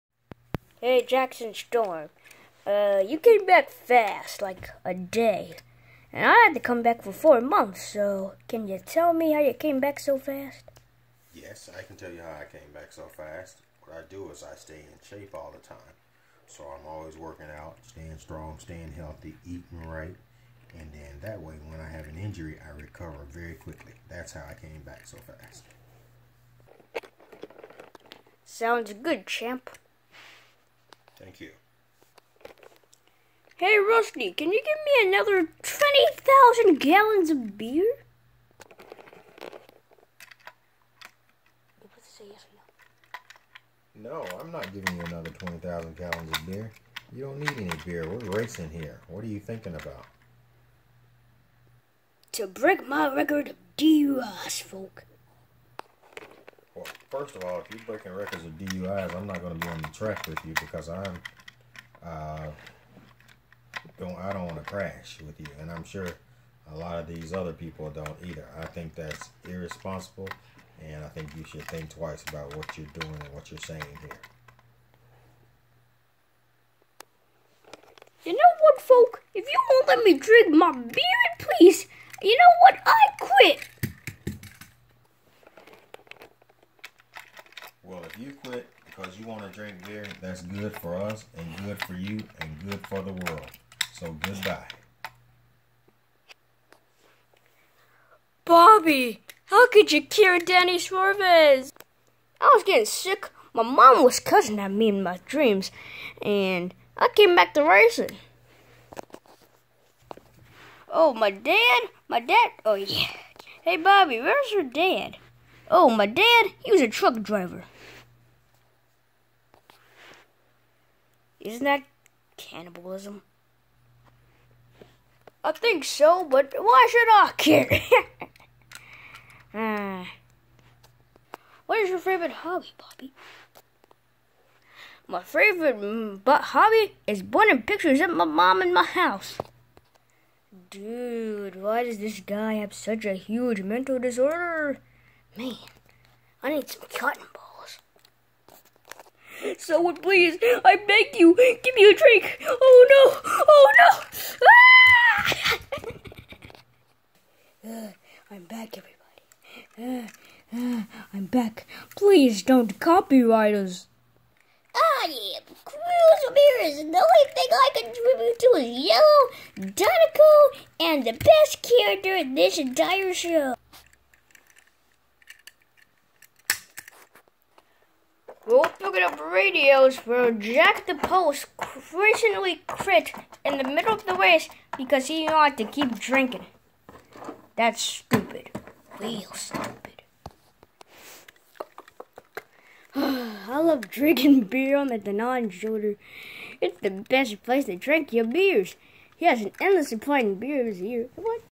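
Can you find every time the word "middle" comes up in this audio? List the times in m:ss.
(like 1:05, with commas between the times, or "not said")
3:03.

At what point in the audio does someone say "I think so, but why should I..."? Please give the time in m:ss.
2:05.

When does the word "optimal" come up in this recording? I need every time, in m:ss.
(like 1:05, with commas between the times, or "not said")
not said.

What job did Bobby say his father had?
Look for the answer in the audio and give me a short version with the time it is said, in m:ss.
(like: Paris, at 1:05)
Truck driver, at 1:56.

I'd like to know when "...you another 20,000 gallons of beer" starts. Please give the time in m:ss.
0:44.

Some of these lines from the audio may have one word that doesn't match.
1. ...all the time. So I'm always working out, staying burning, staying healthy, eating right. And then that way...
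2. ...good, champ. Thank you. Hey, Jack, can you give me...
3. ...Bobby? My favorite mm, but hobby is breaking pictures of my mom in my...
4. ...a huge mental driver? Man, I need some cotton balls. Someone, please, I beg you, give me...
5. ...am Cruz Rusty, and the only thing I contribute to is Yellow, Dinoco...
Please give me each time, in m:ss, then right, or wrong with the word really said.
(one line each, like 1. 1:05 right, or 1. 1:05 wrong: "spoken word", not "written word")
1. 0:15 wrong: "strong", not "burning"
2. 0:28 wrong: "Rusty", not "Jack"
3. 2:12 wrong: "burning", not "breaking"
4. 2:23 wrong: "disorder", not "driver"
5. 2:45 wrong: "Ramirez", not "Rusty".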